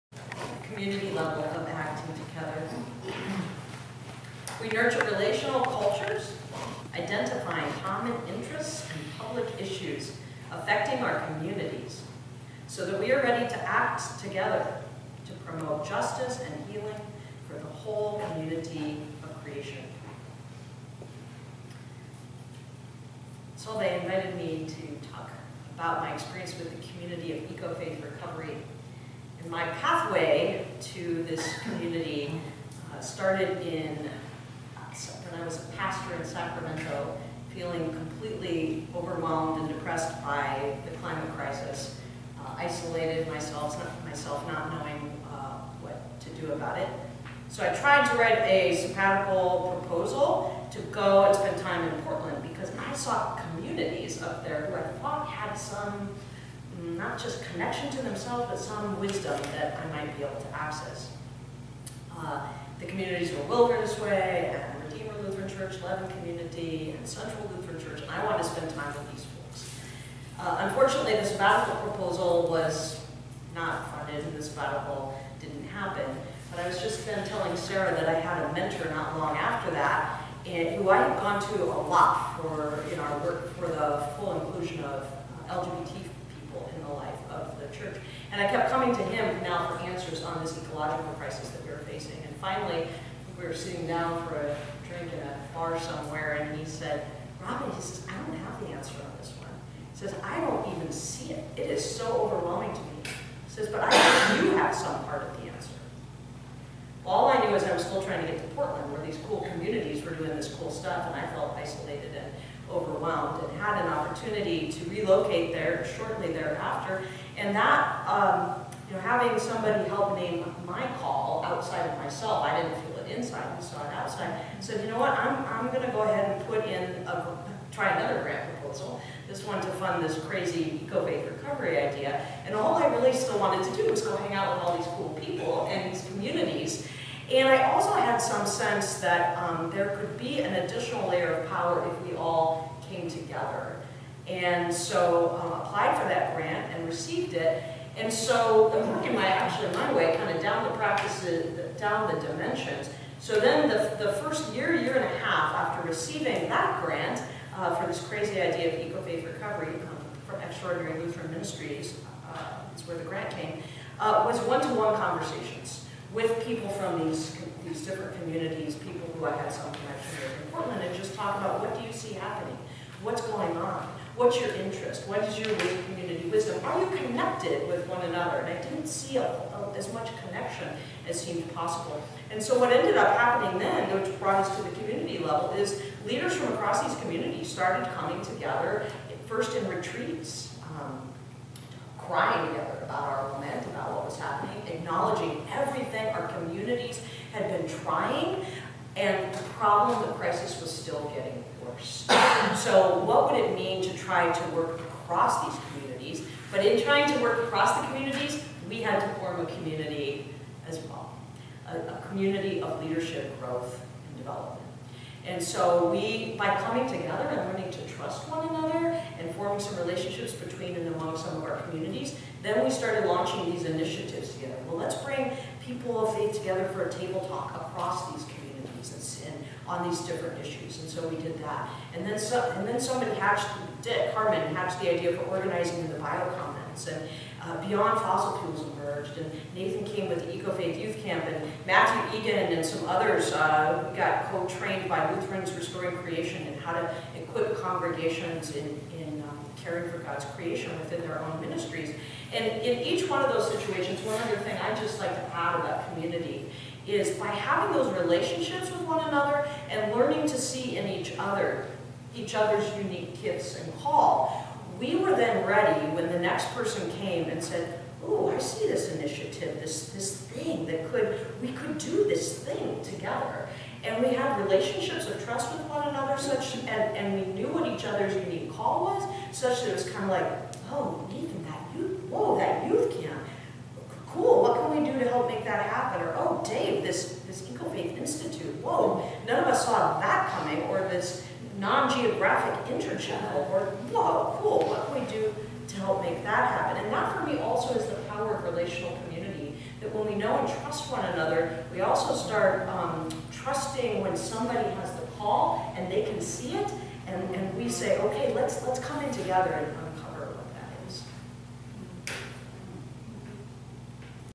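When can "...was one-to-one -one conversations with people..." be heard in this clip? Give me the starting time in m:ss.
2:44.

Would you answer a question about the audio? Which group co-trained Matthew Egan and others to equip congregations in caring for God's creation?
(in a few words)
Lutherans Restoring Creation.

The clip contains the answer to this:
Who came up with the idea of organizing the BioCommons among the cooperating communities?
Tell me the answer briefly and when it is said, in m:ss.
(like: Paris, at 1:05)
Dick Harmon, at 3:53.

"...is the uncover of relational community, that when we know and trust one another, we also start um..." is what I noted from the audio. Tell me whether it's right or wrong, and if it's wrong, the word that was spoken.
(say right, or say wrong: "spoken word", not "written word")
wrong: "power", not "uncover".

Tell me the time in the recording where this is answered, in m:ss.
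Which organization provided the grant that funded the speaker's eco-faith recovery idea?
2:40.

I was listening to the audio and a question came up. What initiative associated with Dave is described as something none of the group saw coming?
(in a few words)
EcoFaith Institute.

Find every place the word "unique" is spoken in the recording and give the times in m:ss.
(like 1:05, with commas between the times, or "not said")
4:22, 4:38.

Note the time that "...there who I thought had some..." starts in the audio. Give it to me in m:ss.
0:54.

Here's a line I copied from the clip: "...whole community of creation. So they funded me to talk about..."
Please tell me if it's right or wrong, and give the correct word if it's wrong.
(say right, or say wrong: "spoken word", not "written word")
wrong: "invited", not "funded".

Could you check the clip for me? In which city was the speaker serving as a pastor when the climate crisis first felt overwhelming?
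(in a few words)
Sacramento.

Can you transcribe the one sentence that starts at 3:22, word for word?
So what would it mean to try to work across these communities?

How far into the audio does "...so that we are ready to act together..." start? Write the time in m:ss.
0:12.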